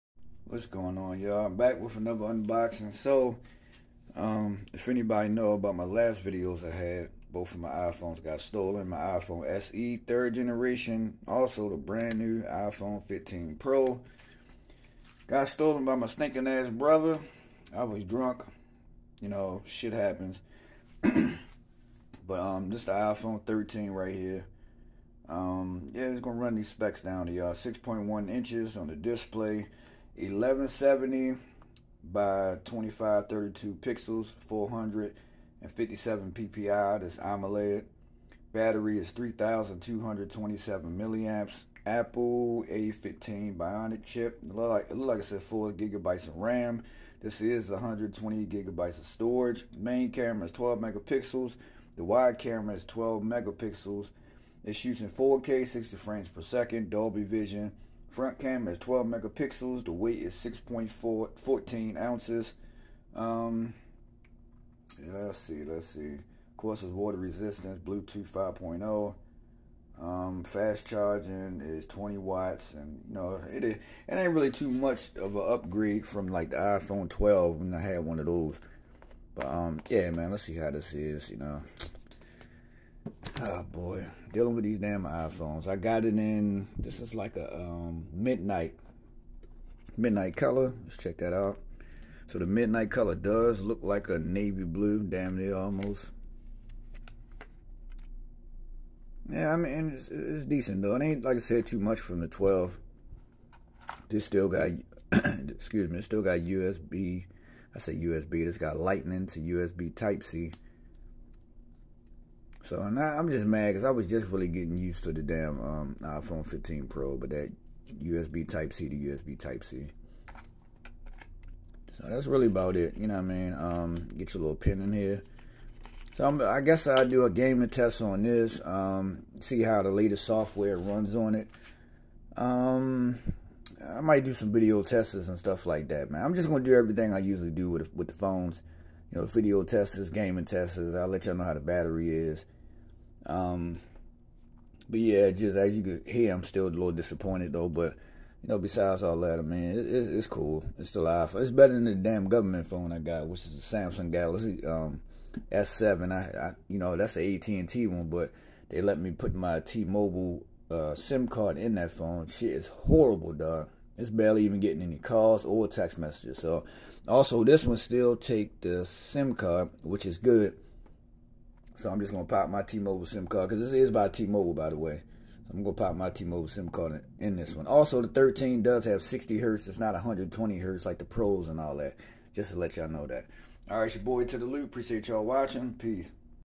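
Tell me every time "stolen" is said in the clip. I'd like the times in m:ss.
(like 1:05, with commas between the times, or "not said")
0:08, 0:15.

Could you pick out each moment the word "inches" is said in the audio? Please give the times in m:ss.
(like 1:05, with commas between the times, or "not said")
0:28.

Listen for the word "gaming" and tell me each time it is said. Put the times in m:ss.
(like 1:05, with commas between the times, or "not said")
2:07, 2:20.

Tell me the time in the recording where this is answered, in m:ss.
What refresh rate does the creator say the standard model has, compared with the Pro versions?
2:59.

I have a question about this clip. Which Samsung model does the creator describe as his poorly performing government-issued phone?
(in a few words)
Galaxy S7.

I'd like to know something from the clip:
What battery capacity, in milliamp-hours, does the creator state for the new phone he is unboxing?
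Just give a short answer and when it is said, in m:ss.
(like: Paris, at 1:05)
3,227, at 0:39.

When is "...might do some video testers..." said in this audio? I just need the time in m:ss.
2:13.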